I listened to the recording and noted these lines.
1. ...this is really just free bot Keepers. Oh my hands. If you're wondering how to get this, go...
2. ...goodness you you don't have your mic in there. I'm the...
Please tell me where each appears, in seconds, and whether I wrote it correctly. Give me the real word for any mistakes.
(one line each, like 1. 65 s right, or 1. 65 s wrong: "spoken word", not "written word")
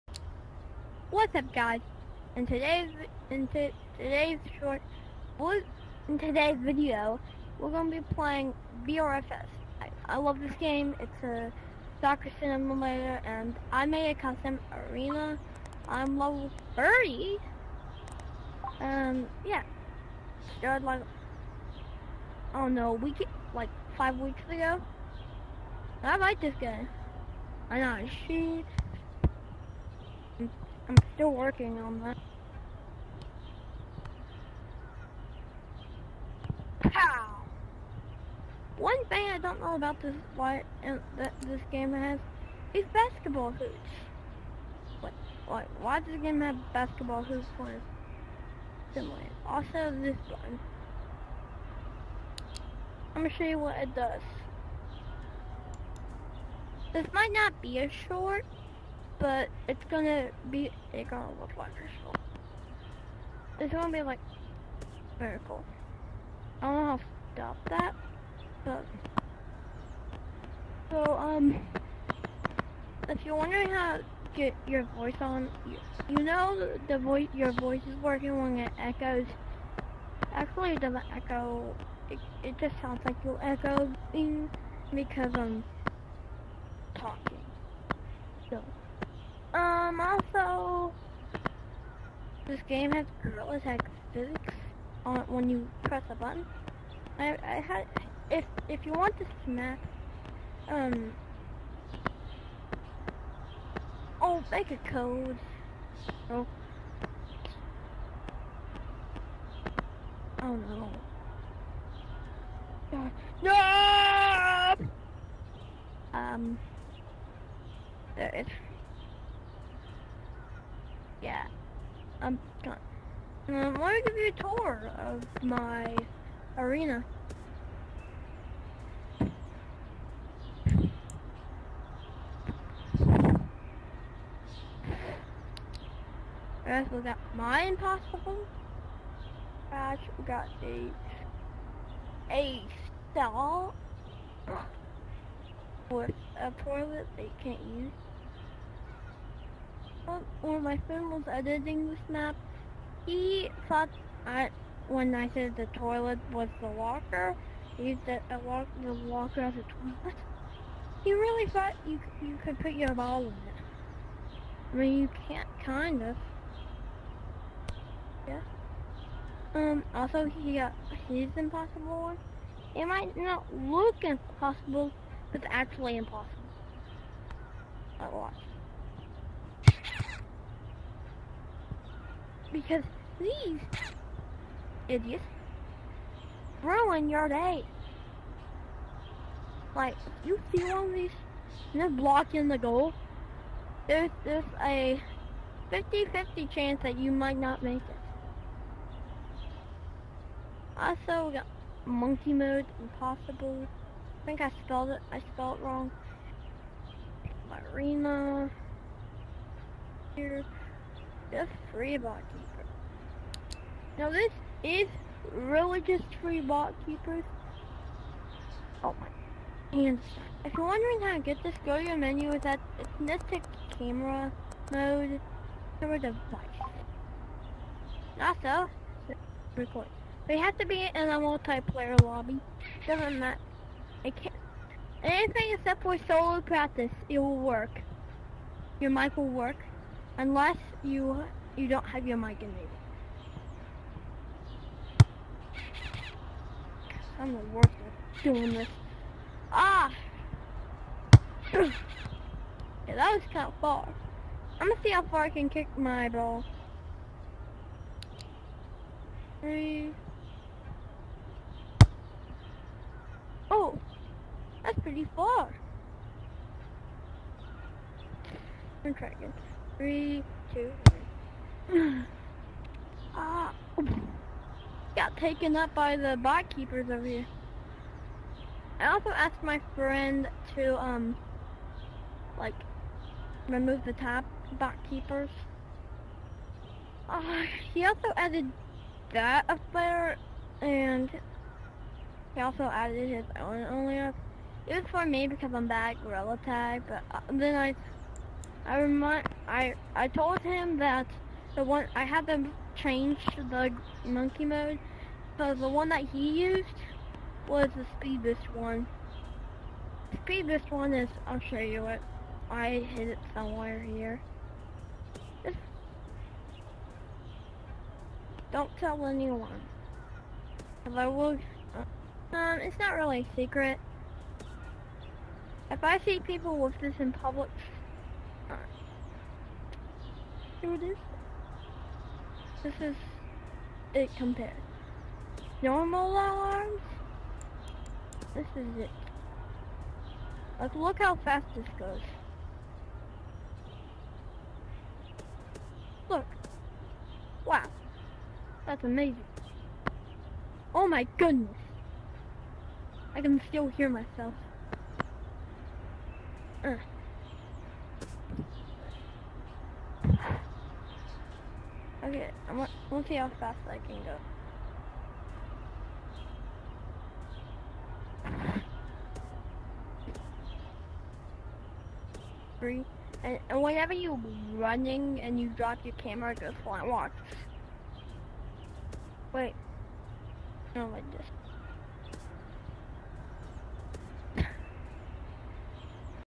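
1. 214 s right
2. 240 s wrong: "unless", not "goodness".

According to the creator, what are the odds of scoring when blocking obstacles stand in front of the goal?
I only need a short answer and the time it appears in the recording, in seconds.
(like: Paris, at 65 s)
50-50, at 195 s.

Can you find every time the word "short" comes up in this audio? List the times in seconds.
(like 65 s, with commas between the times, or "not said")
4 s, 58 s.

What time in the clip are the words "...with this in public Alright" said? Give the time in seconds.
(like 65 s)
326 s.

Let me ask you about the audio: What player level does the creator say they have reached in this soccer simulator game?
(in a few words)
30.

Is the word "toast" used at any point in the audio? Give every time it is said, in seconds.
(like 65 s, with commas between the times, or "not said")
not said.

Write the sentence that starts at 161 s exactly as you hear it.
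He really thought you you could put your ball in it.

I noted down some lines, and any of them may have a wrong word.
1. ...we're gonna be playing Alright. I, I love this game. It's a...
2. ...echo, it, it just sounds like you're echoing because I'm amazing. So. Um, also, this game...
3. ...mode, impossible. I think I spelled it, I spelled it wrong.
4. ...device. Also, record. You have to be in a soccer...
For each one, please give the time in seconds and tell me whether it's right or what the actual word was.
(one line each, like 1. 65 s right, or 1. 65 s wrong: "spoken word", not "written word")
1. 7 s wrong: "VRFS", not "Alright"
2. 81 s wrong: "talking", not "amazing"
3. 202 s right
4. 225 s wrong: "multiplayer", not "soccer".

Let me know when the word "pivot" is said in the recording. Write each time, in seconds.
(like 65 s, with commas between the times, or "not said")
not said.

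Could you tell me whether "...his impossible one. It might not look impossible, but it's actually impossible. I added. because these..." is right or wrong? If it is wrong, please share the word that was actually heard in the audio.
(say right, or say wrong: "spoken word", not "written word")
wrong: "watched", not "added".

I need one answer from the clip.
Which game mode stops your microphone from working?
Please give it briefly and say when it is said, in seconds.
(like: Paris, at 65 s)
Solo practice, at 236 s.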